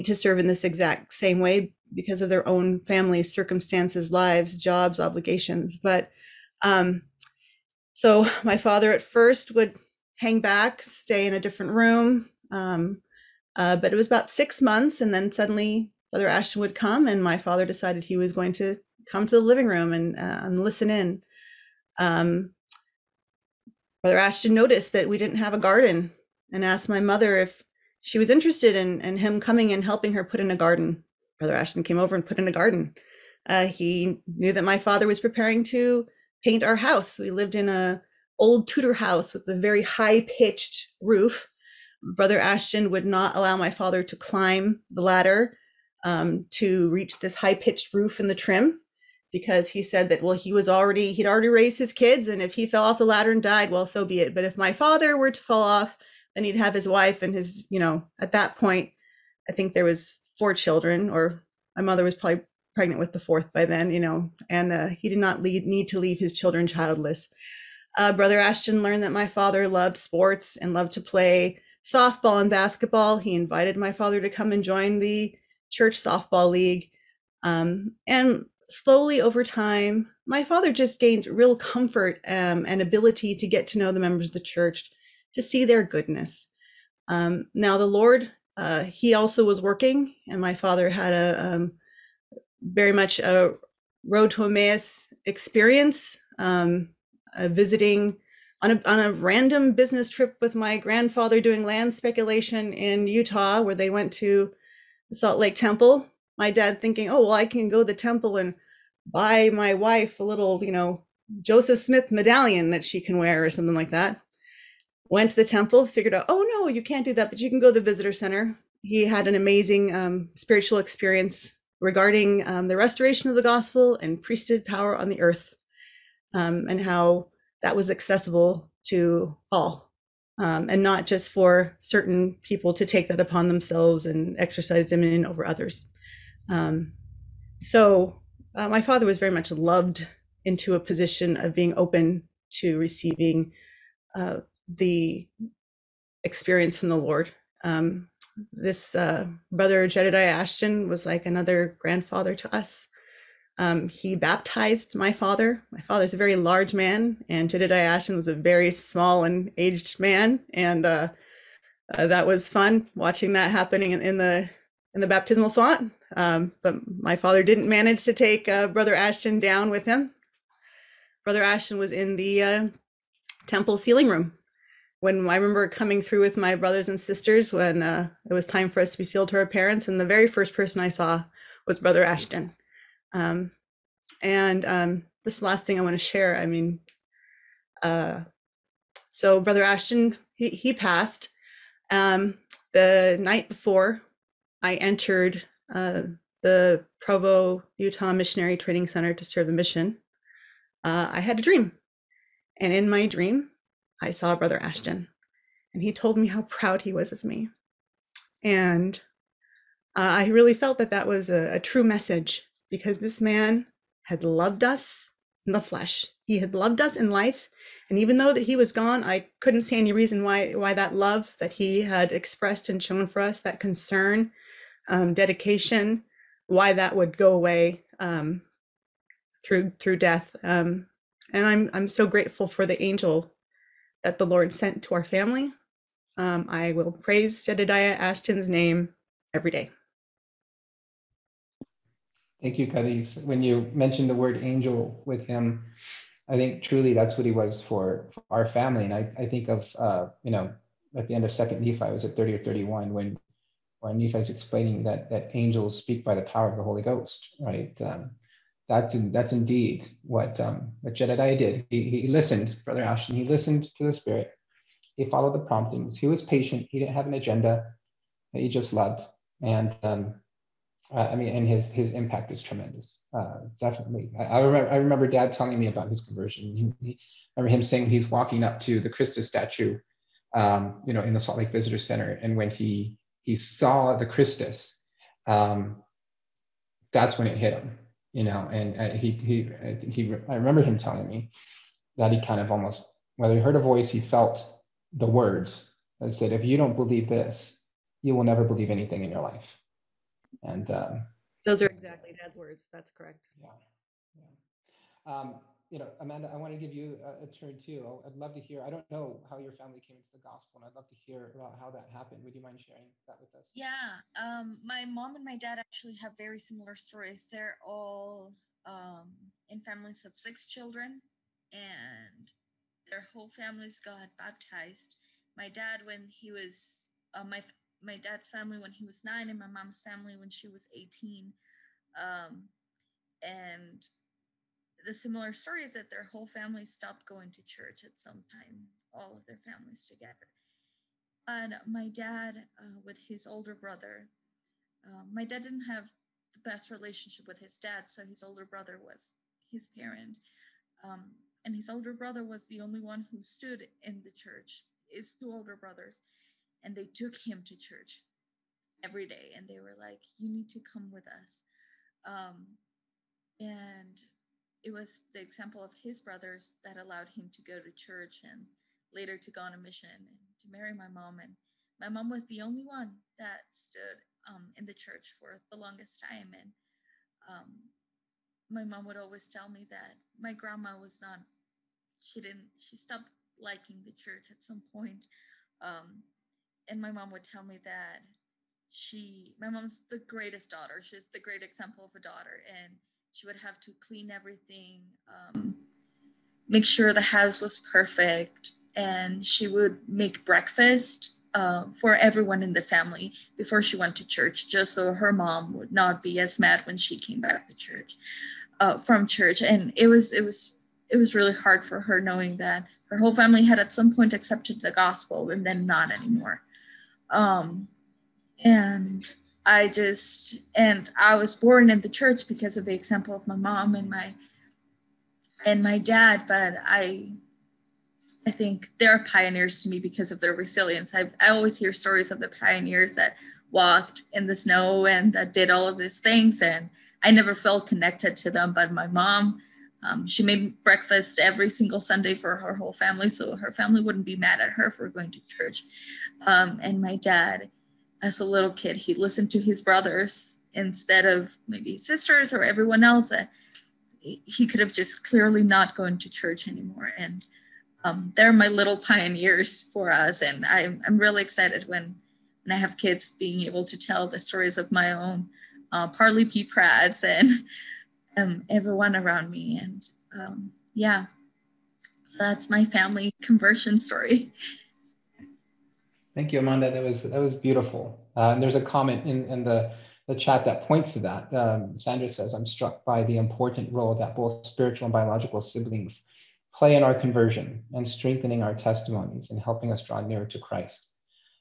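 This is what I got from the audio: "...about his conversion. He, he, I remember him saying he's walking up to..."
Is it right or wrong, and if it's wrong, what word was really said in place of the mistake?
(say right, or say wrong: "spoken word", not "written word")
right.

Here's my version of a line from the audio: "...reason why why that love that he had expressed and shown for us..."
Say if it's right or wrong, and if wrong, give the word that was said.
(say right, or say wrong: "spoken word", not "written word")
right.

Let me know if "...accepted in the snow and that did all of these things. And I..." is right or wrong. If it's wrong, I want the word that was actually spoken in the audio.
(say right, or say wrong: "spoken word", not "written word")
wrong: "walked", not "accepted".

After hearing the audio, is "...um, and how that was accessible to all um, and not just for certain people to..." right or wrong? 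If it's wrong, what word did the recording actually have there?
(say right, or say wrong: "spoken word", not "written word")
right.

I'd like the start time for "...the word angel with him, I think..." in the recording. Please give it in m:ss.
4:04.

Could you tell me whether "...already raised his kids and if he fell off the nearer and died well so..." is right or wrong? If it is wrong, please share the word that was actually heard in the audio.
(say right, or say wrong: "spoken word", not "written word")
wrong: "ladder", not "nearer".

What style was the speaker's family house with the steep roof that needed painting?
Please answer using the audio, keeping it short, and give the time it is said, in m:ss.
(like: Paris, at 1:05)
Tudor, at 0:38.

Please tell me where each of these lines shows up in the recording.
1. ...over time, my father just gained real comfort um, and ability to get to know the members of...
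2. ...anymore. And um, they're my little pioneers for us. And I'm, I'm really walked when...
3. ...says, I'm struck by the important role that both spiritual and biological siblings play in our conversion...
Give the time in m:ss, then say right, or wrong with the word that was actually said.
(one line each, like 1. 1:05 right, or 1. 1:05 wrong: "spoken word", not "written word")
1. 1:19 right
2. 7:36 wrong: "excited", not "walked"
3. 8:02 right.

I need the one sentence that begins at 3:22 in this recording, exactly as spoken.
And in my dream, I saw Brother Ashton and he told me how proud he was of me.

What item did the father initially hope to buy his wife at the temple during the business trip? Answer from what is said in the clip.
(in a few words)
Joseph Smith medallion.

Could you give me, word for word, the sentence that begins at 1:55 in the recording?
Went to the temple, figured out, oh, no, you can't do that, but you can go to the visitor center.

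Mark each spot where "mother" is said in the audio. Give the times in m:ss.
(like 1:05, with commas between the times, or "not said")
0:26, 1:01.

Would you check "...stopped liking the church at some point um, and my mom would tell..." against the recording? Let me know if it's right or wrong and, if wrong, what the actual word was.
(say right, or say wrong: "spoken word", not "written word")
right.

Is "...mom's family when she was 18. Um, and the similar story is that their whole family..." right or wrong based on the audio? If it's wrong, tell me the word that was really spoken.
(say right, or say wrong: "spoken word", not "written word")
right.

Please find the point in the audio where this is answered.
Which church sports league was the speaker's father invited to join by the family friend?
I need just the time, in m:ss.
1:15.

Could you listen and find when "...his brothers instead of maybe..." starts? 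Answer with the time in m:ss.
7:29.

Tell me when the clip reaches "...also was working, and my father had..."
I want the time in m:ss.
1:29.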